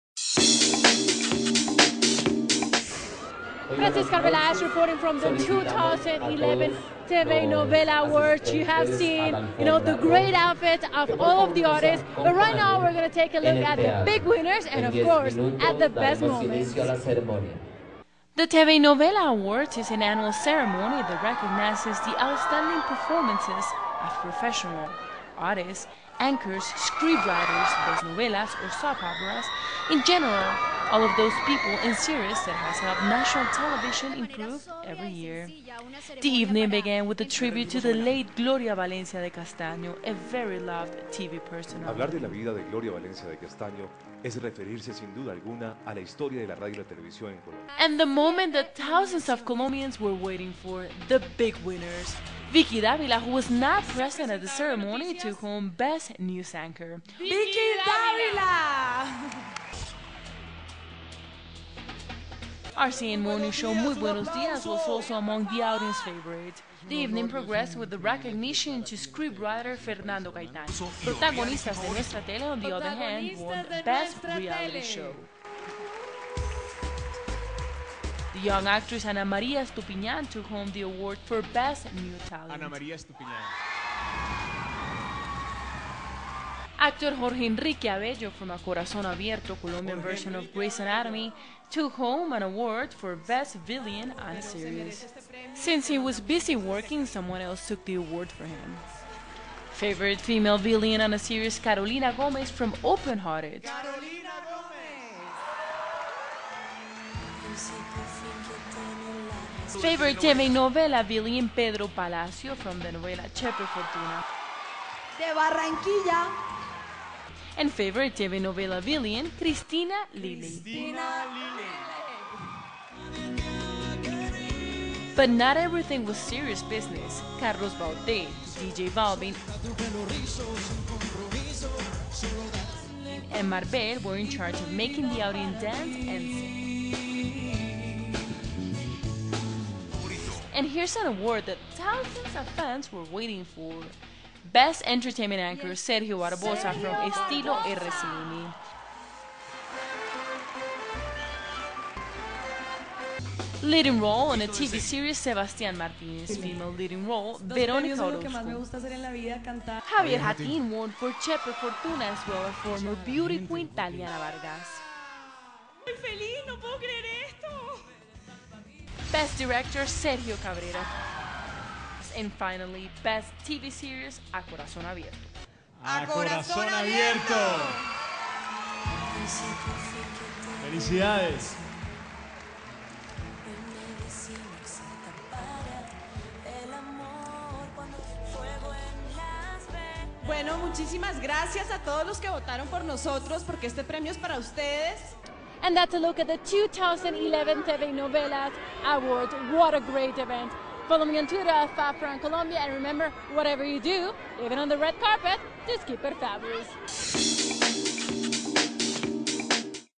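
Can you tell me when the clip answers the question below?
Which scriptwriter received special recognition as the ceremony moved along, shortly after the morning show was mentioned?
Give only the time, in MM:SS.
01:09.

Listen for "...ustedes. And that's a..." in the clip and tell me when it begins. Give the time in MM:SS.
03:14.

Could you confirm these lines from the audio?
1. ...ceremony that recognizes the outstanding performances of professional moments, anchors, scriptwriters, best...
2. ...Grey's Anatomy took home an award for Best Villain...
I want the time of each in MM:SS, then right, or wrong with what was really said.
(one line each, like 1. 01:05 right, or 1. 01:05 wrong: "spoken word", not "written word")
1. 00:20 wrong: "artists", not "moments"
2. 01:30 right.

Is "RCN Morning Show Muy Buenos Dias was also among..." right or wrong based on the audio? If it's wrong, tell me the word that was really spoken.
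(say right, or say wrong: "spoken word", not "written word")
right.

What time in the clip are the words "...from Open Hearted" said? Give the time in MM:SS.
01:42.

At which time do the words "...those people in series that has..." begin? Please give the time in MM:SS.
00:31.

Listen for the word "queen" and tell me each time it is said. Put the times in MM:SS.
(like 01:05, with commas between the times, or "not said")
02:43.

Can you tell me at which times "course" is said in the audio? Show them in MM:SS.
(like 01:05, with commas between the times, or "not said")
00:15.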